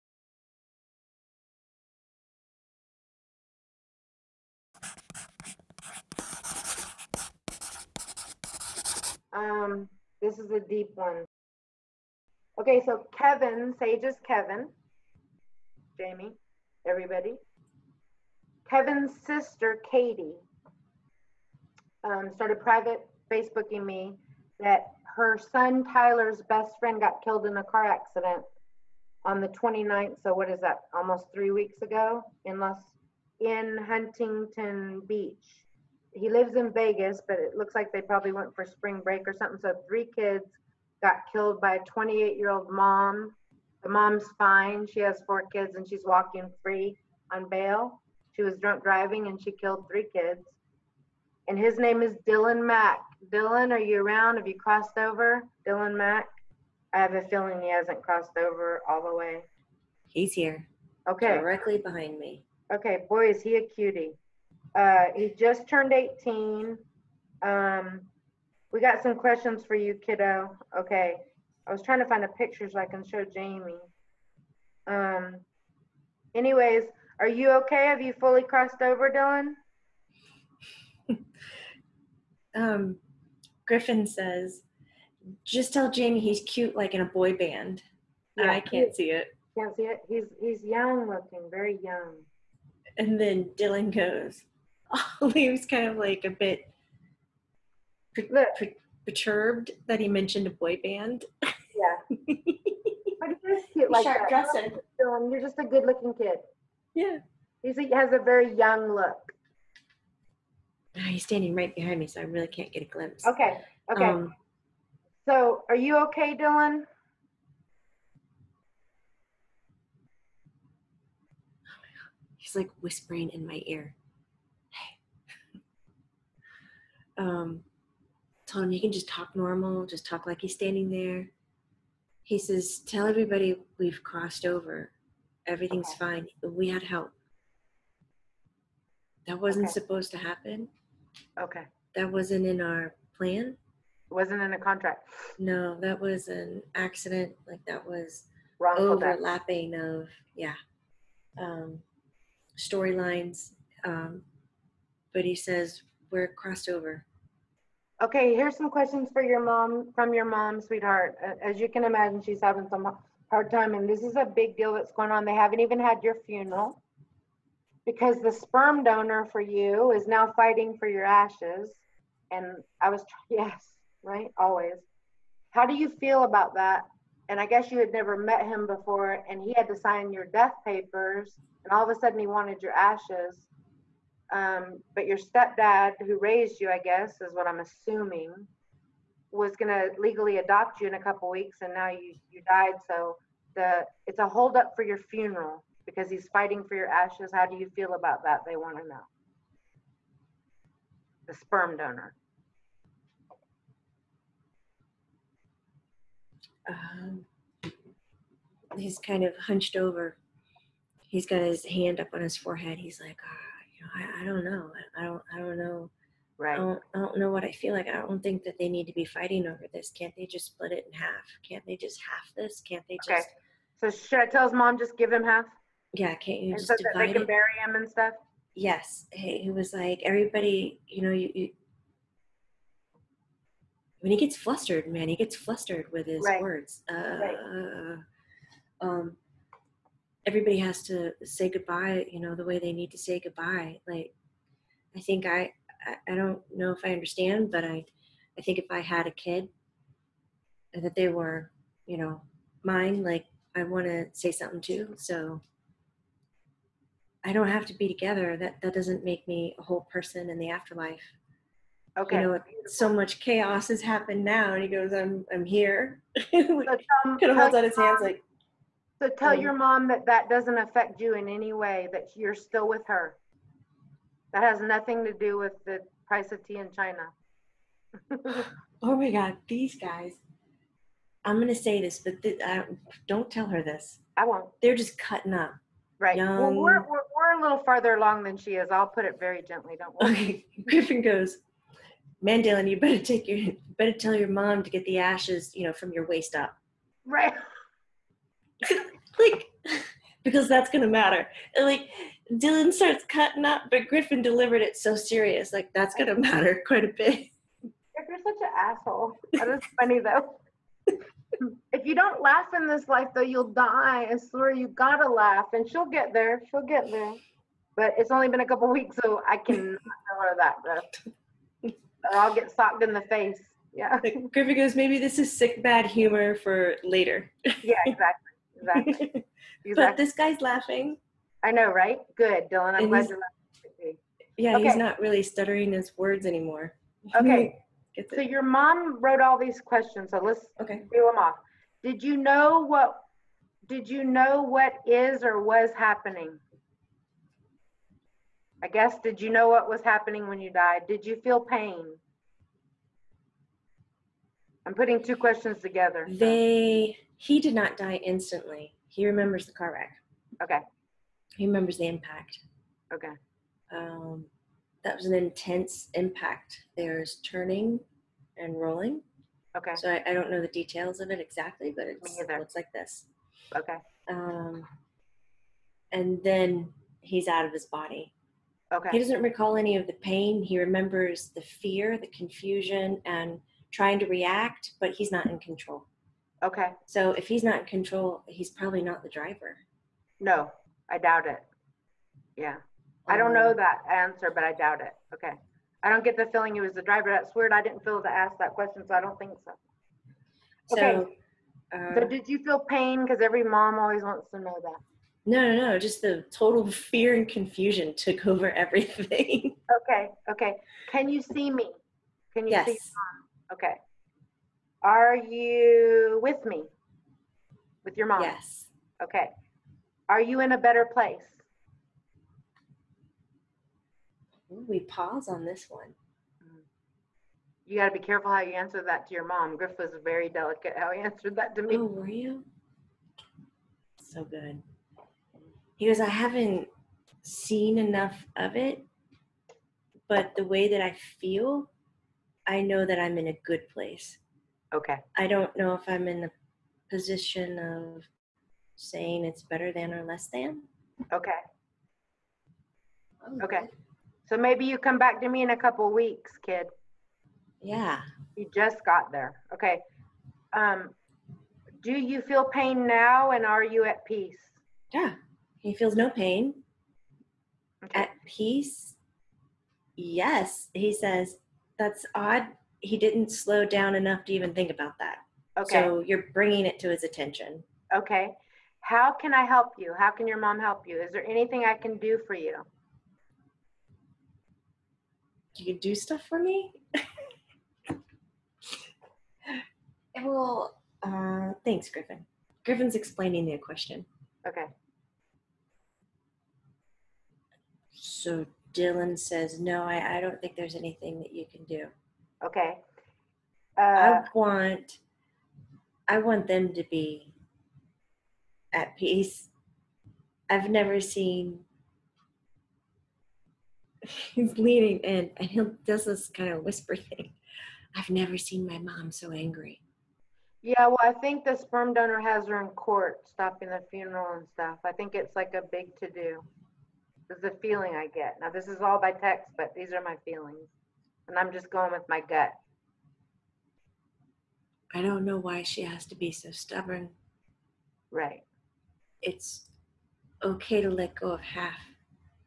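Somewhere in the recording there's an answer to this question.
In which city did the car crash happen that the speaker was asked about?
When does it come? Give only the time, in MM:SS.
00:33.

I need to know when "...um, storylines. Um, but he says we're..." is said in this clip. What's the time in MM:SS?
02:31.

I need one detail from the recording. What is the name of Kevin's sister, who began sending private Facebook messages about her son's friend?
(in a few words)
Katie.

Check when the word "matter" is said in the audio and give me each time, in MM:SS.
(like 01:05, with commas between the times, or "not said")
05:00, 05:06.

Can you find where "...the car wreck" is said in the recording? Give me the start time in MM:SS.
05:59.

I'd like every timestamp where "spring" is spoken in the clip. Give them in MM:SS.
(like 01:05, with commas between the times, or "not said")
00:38.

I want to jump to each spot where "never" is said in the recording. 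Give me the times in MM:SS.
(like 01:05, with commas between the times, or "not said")
02:57, 08:30, 08:38.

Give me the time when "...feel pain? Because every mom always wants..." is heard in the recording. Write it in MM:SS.
06:42.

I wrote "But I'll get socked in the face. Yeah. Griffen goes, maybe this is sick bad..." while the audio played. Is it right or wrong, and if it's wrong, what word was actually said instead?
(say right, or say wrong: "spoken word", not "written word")
right.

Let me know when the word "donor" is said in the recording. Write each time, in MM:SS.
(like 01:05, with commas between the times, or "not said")
02:48, 03:21, 08:41.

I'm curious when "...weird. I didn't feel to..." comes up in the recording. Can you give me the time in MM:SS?
06:37.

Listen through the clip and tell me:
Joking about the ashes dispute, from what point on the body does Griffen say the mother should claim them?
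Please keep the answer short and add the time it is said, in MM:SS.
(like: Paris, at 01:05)
waist up, at 04:56.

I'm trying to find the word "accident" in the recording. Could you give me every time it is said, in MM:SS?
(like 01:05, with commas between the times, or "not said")
00:27, 02:26.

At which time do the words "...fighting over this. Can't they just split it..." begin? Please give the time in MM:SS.
03:39.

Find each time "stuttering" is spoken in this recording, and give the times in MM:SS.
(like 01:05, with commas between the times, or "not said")
05:35.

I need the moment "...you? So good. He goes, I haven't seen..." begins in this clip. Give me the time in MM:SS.
07:12.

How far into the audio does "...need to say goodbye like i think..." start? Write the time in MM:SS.
04:02.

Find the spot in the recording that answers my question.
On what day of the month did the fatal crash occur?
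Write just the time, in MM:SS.
00:29.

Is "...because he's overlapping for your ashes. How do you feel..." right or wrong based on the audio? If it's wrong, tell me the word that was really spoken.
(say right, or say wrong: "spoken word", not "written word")
wrong: "fighting", not "overlapping".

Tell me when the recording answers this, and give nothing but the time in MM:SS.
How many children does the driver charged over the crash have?
00:45.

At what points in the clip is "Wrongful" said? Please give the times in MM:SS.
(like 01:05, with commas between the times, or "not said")
02:28.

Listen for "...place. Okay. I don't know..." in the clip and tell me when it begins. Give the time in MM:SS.
07:23.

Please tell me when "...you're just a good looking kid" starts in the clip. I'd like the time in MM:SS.
01:45.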